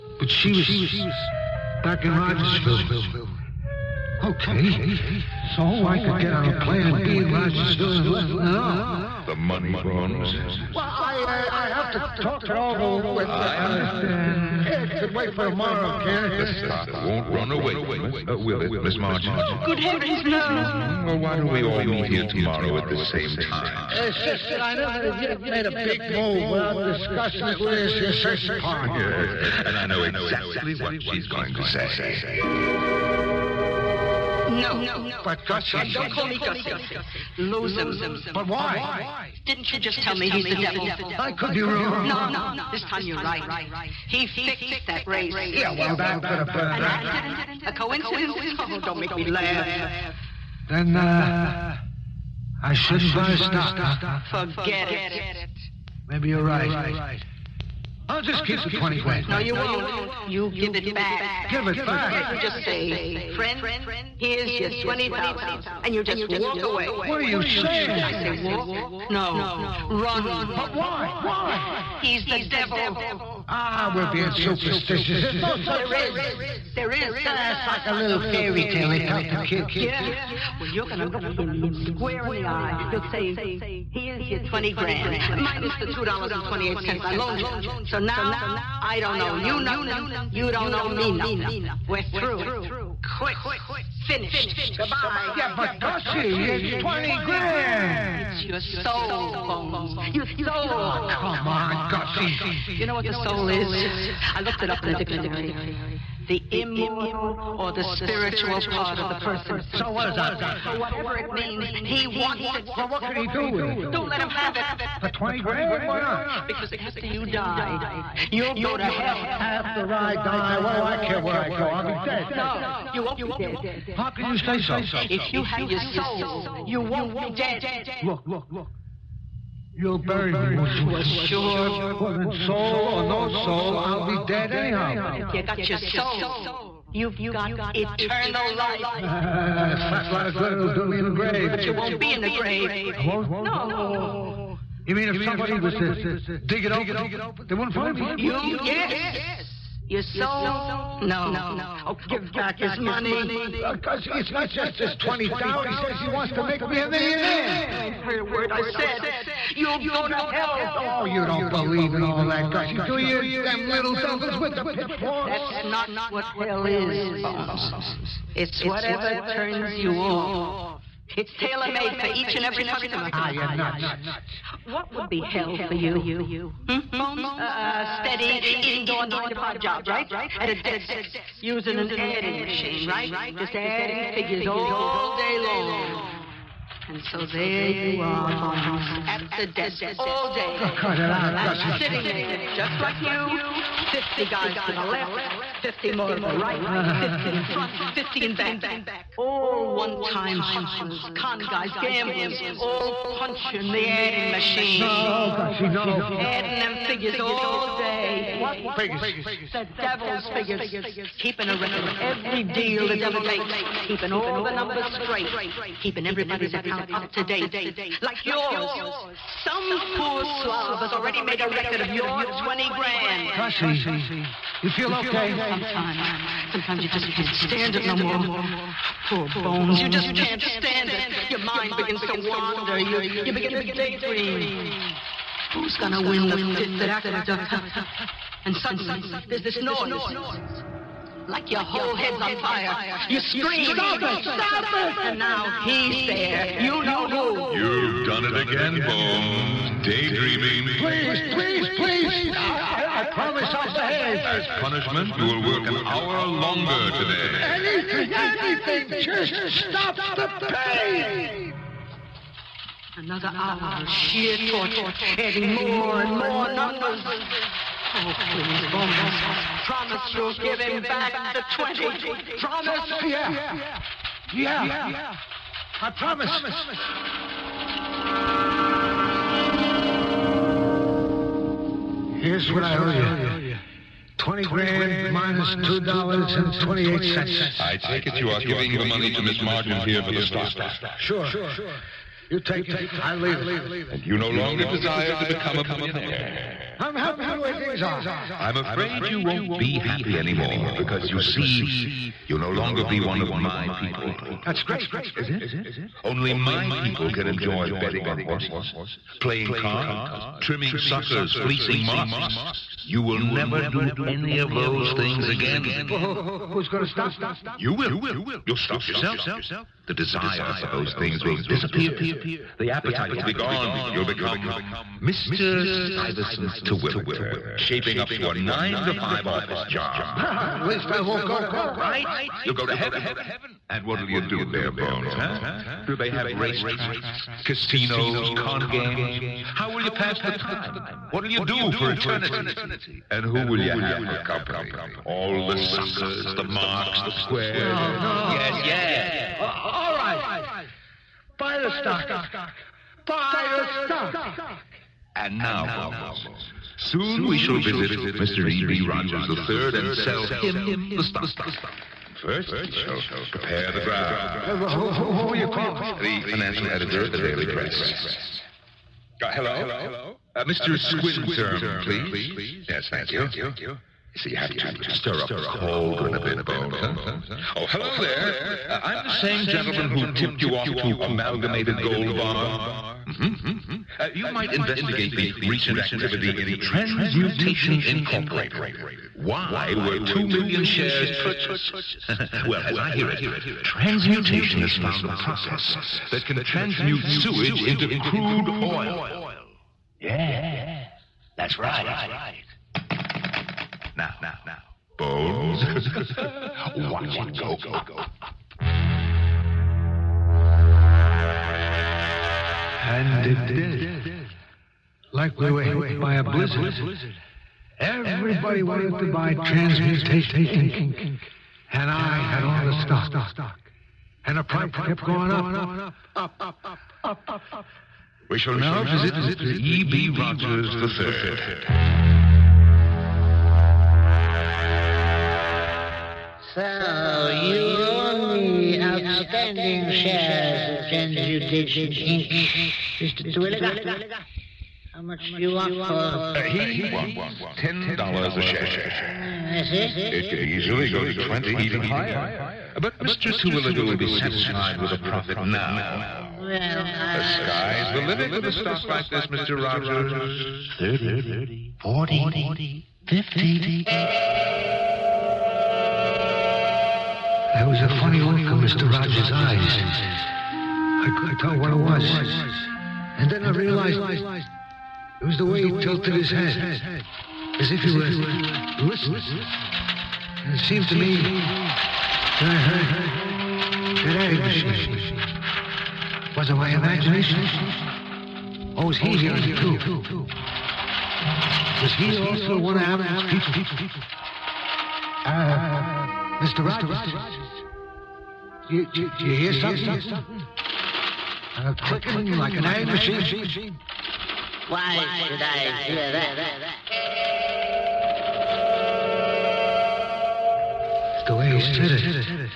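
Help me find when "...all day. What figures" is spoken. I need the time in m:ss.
3:27.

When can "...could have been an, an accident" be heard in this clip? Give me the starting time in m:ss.
0:46.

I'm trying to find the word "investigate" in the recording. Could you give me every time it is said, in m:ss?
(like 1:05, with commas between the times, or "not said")
6:24.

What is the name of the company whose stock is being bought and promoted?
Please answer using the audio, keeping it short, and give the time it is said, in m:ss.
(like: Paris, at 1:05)
Transmutation Incorporated, at 6:26.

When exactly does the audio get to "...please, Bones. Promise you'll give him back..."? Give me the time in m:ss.
4:28.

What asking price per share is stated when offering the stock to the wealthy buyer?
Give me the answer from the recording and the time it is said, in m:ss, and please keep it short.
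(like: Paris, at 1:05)
$10, at 7:27.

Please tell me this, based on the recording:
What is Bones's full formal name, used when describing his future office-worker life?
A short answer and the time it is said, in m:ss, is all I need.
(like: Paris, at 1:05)
Stuyvesant Terwilliger, at 5:25.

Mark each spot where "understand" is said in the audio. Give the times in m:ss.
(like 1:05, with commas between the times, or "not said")
0:13.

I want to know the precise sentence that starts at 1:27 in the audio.
So now, I don't owe you nothing.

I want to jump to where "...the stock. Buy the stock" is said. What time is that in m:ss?
5:51.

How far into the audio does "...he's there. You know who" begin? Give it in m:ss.
4:05.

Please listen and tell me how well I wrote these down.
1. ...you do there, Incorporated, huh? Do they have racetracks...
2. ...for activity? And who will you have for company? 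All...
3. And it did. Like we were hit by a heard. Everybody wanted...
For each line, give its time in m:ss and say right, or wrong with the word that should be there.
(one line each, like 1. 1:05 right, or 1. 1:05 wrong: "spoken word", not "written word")
1. 5:34 wrong: "Bones", not "Incorporated"
2. 5:41 wrong: "eternity", not "activity"
3. 6:52 wrong: "blizzard", not "heard".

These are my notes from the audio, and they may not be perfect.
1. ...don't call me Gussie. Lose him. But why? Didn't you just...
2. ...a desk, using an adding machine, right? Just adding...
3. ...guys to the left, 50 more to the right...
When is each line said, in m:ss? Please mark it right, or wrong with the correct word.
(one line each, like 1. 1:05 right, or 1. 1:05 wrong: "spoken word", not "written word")
1. 0:35 right
2. 3:00 right
3. 3:14 right.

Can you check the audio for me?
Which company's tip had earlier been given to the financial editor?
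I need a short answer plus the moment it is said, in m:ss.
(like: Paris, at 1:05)
Amalgamated Gold Bar, at 6:21.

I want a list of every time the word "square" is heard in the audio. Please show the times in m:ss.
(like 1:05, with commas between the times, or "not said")
1:21, 5:47.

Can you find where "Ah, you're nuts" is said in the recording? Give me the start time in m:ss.
2:53.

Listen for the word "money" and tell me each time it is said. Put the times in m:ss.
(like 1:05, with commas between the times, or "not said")
0:09, 2:32, 4:48.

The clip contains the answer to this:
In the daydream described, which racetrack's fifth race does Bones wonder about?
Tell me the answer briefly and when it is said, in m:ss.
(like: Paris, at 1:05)
Aqueduct, at 3:56.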